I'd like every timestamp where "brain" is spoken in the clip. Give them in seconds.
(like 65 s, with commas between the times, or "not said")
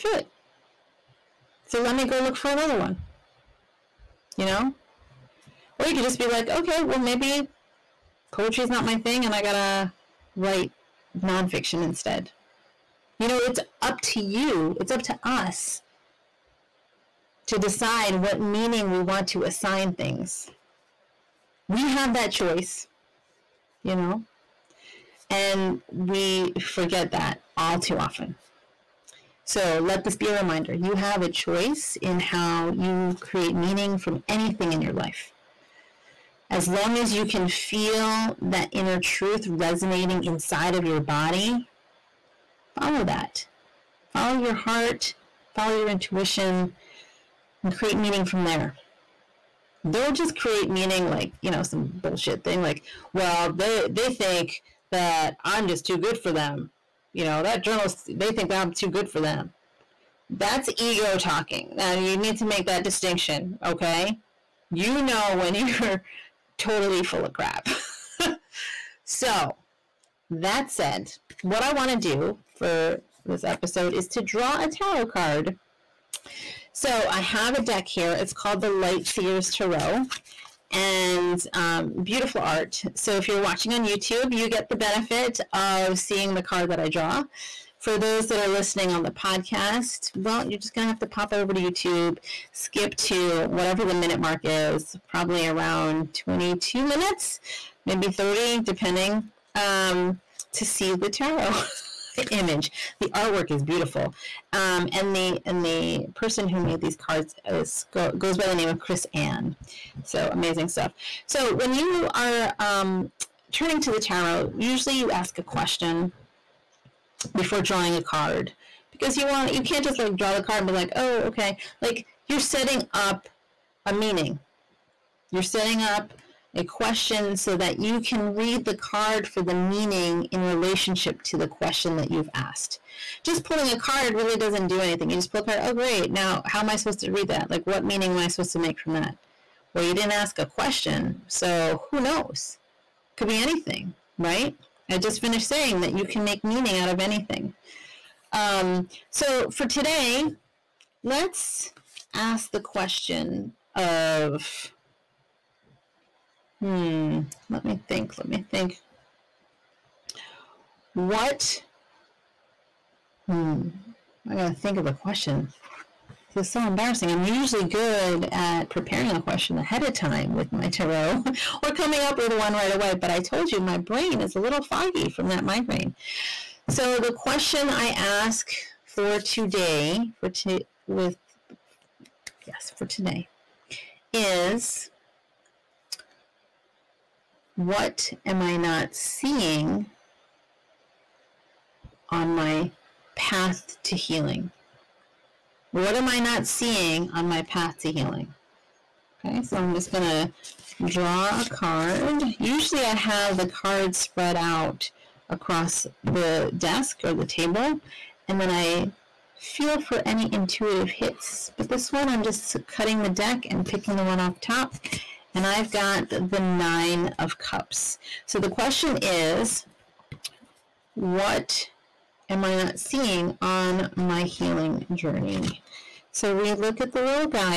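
173 s.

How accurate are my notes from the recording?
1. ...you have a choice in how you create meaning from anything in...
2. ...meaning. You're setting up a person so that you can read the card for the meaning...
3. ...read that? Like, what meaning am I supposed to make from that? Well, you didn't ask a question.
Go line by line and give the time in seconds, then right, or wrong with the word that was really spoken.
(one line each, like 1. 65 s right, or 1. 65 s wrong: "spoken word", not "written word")
1. 30 s right
2. 123 s wrong: "question", not "person"
3. 137 s right.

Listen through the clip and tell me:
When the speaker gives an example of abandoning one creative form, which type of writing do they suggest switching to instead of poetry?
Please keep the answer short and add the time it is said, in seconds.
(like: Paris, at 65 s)
nonfiction, at 11 s.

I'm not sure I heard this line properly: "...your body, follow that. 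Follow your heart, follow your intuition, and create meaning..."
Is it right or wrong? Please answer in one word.
right.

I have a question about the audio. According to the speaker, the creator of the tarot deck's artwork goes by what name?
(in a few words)
Chris Ann.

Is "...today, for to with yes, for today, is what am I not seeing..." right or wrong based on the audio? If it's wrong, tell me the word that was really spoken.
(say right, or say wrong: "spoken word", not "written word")
right.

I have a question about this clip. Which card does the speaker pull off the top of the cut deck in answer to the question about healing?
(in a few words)
Nine of Cups.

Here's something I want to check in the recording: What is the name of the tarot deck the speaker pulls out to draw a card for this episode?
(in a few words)
Light Seers Tarot.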